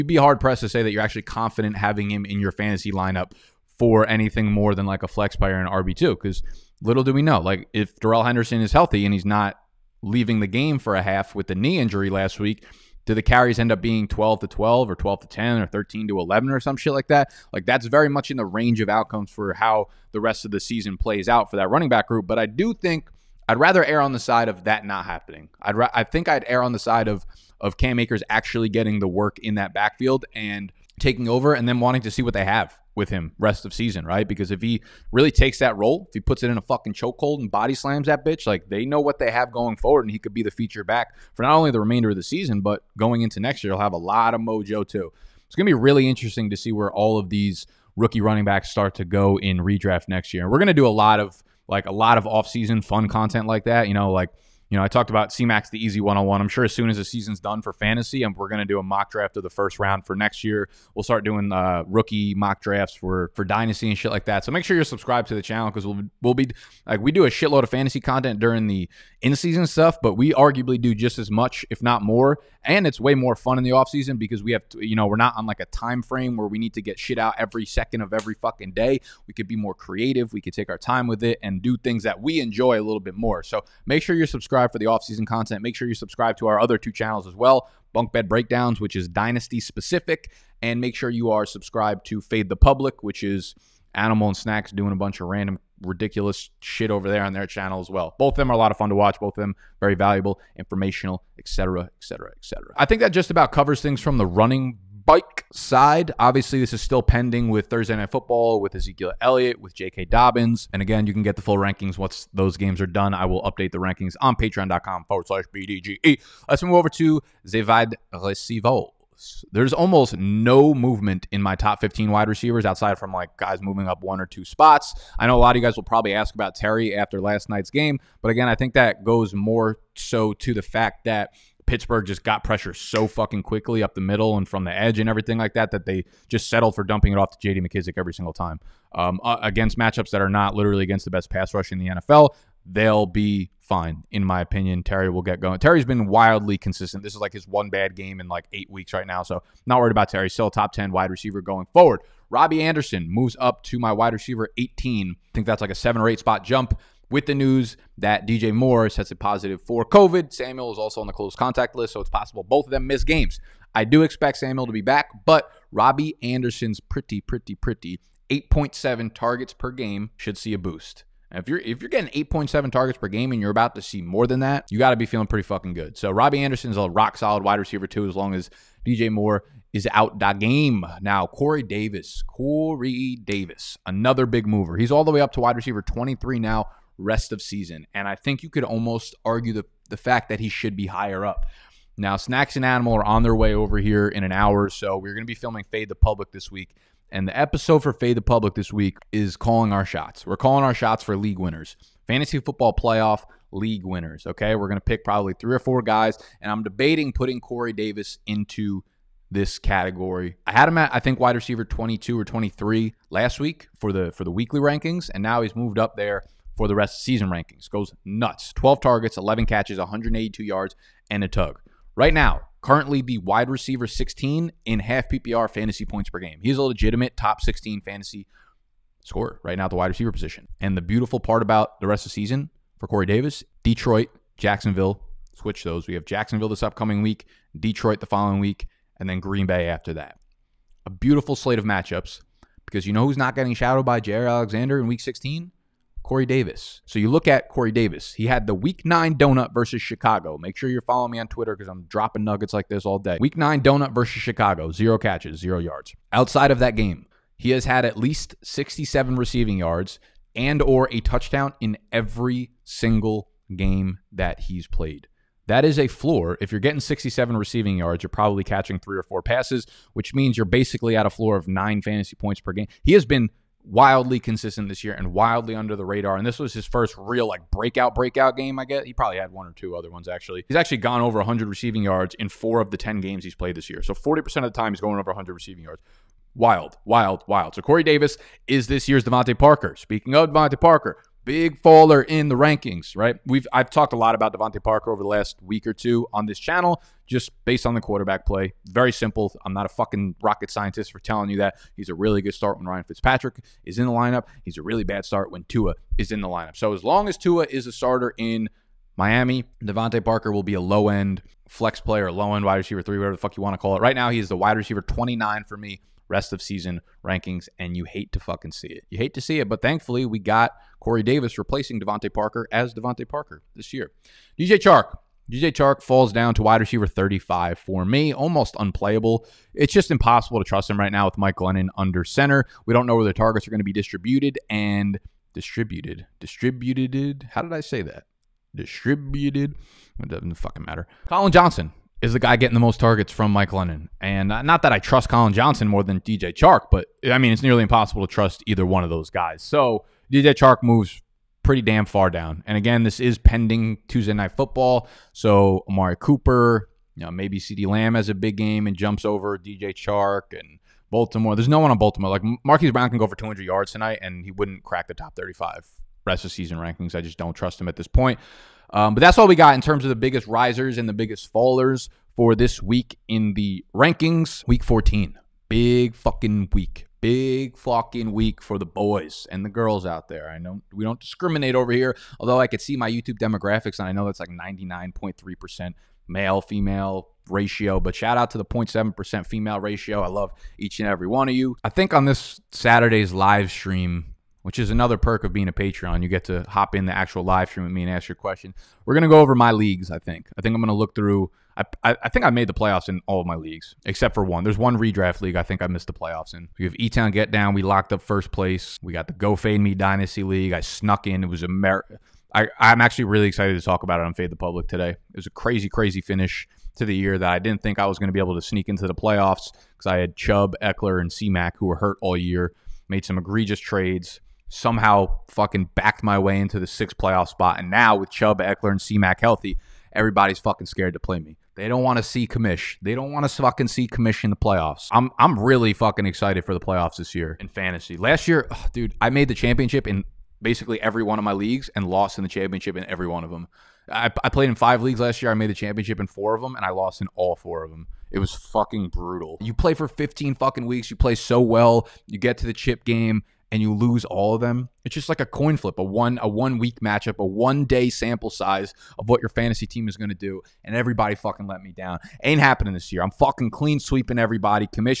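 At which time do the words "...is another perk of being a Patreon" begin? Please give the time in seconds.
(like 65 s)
394 s.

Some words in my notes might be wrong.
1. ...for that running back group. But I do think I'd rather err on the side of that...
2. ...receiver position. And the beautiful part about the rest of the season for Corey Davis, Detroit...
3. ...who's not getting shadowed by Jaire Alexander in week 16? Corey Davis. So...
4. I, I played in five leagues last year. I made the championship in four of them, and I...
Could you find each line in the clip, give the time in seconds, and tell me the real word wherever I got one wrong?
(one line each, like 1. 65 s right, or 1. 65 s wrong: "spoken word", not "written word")
1. 21 s right
2. 229 s right
3. 243 s right
4. 443 s right.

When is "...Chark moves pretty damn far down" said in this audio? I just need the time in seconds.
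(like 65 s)
350 s.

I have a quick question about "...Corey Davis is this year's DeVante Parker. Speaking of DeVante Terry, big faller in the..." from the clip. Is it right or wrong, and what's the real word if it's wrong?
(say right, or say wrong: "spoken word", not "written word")
wrong: "Parker", not "Terry".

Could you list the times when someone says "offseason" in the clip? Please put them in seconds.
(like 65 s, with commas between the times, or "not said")
52 s, 73 s, 84 s.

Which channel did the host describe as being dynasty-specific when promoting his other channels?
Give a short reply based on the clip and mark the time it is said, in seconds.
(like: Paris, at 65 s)
Bunk Bed Breakdowns, at 87 s.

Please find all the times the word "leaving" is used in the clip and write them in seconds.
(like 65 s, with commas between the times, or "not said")
10 s.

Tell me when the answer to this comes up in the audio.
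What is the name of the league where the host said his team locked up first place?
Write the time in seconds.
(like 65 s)
406 s.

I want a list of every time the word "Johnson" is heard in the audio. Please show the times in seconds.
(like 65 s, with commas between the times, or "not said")
341 s, 345 s.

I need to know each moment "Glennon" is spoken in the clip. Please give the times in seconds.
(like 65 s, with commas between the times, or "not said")
331 s, 343 s.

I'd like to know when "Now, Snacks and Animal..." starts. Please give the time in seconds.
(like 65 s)
191 s.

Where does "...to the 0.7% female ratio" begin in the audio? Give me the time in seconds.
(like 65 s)
388 s.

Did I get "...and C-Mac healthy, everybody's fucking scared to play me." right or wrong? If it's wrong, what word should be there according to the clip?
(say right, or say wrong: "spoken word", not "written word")
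right.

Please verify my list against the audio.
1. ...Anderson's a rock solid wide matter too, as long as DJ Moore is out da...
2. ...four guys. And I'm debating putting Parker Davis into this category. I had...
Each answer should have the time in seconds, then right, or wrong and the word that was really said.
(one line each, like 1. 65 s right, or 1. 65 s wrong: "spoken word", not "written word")
1. 176 s wrong: "receiver", not "matter"
2. 205 s wrong: "Corey", not "Parker".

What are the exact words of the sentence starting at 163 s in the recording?
I do expect Samuel to be back, but Robbie Anderson's pretty, pretty, pretty 8.7 targets per game should see a boost.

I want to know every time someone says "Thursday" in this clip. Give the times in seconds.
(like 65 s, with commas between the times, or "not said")
107 s.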